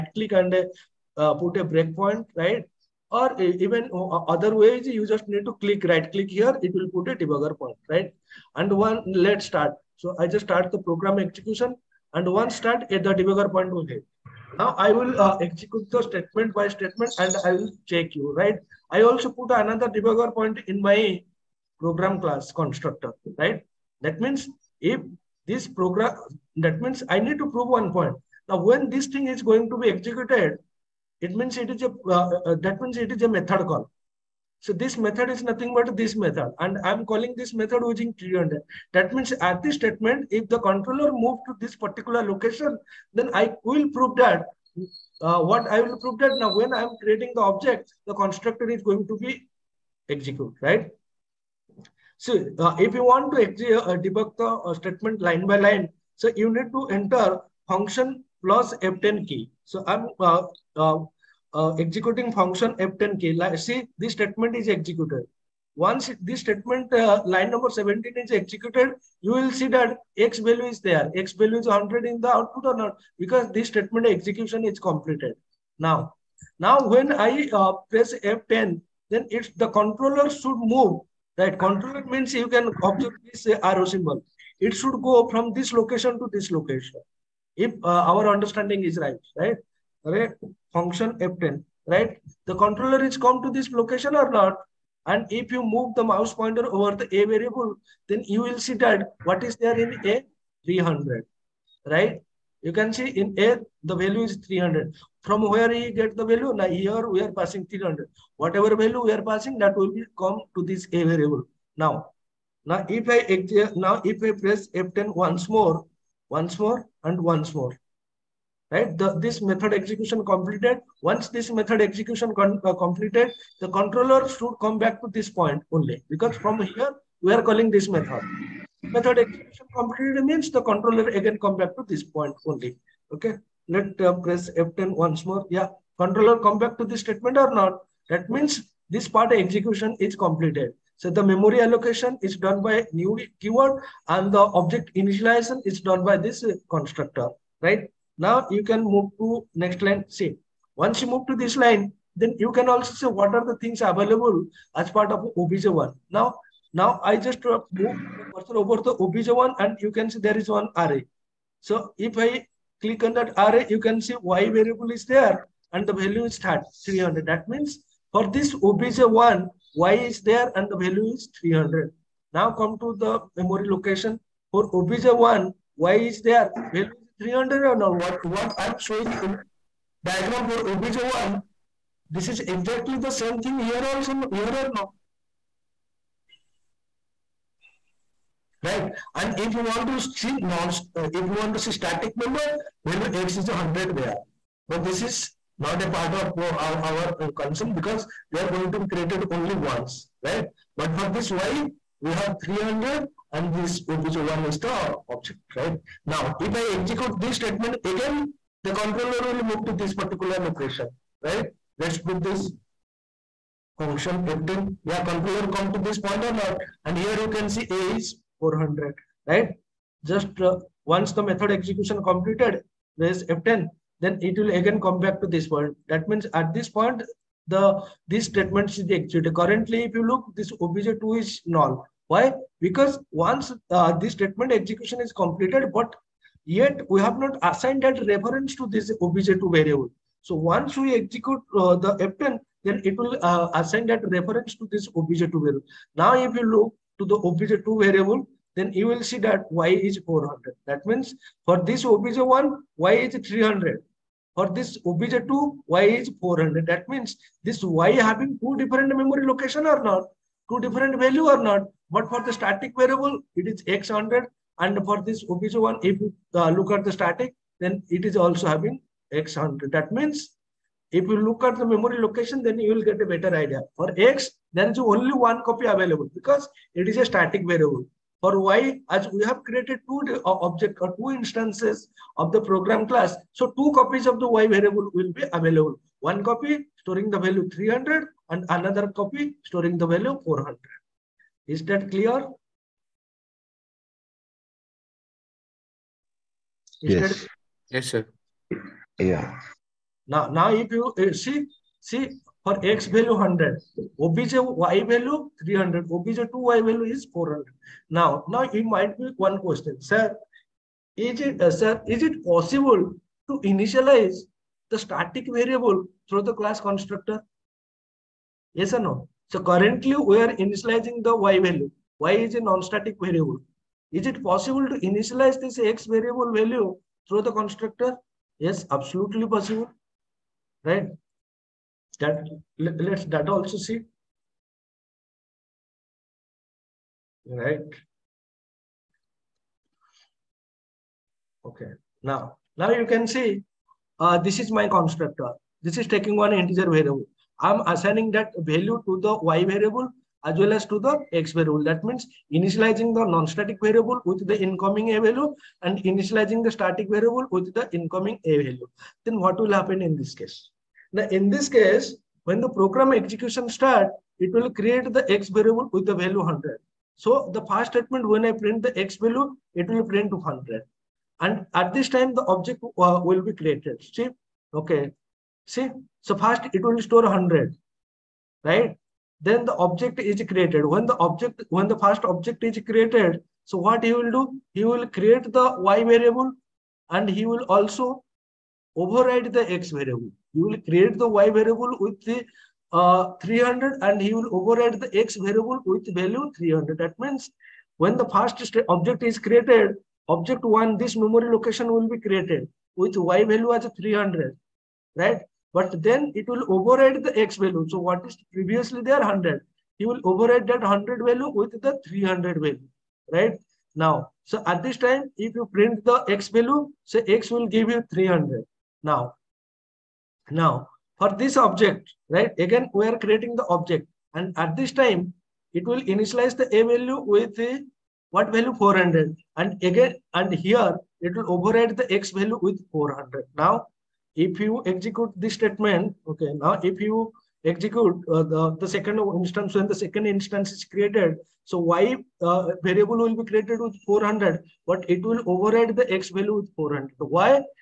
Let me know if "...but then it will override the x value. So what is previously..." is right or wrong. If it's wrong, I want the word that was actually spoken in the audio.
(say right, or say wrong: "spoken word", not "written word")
right.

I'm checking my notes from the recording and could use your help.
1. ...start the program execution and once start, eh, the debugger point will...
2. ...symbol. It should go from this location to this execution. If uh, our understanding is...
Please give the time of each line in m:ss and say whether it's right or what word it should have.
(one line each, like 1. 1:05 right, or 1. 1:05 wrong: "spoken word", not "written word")
1. 0:10 right
2. 1:23 wrong: "location", not "execution".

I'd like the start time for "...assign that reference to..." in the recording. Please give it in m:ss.
4:03.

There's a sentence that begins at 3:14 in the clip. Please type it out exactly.
But this is not a part of our, our uh, concern because they are going to be created only once, right?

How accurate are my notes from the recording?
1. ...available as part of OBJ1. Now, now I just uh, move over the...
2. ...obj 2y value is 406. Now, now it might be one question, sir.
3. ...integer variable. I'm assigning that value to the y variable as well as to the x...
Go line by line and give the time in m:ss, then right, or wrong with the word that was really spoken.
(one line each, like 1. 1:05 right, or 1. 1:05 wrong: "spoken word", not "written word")
1. 2:33 right
2. 5:05 wrong: "400", not "406"
3. 5:46 right.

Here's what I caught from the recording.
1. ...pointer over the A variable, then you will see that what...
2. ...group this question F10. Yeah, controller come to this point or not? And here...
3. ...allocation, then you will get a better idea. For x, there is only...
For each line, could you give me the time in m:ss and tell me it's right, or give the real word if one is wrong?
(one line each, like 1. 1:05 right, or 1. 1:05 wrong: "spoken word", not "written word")
1. 1:36 right
2. 3:31 wrong: "function", not "question"
3. 4:31 wrong: "location", not "allocation".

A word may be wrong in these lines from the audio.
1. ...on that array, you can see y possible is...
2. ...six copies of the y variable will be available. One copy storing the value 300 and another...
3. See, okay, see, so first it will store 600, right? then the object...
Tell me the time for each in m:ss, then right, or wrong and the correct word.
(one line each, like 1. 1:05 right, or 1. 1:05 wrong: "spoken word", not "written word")
1. 2:43 wrong: "variable", not "possible"
2. 4:43 wrong: "two", not "six"
3. 6:13 wrong: "100", not "600".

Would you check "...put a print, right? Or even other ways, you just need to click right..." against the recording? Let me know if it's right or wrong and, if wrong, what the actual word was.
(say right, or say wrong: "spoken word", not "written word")
wrong: "breakpoint", not "print".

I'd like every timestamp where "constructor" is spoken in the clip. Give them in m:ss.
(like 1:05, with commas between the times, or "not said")
0:22, 0:48, 2:26, 5:16, 5:27, 5:44.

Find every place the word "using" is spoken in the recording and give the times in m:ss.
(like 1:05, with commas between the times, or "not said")
0:37.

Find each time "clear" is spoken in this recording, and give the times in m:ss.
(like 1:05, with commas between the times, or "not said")
4:51.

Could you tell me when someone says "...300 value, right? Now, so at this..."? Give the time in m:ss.
6:51.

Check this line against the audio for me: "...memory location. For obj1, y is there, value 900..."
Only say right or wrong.
wrong.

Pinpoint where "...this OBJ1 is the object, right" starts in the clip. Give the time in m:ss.
3:23.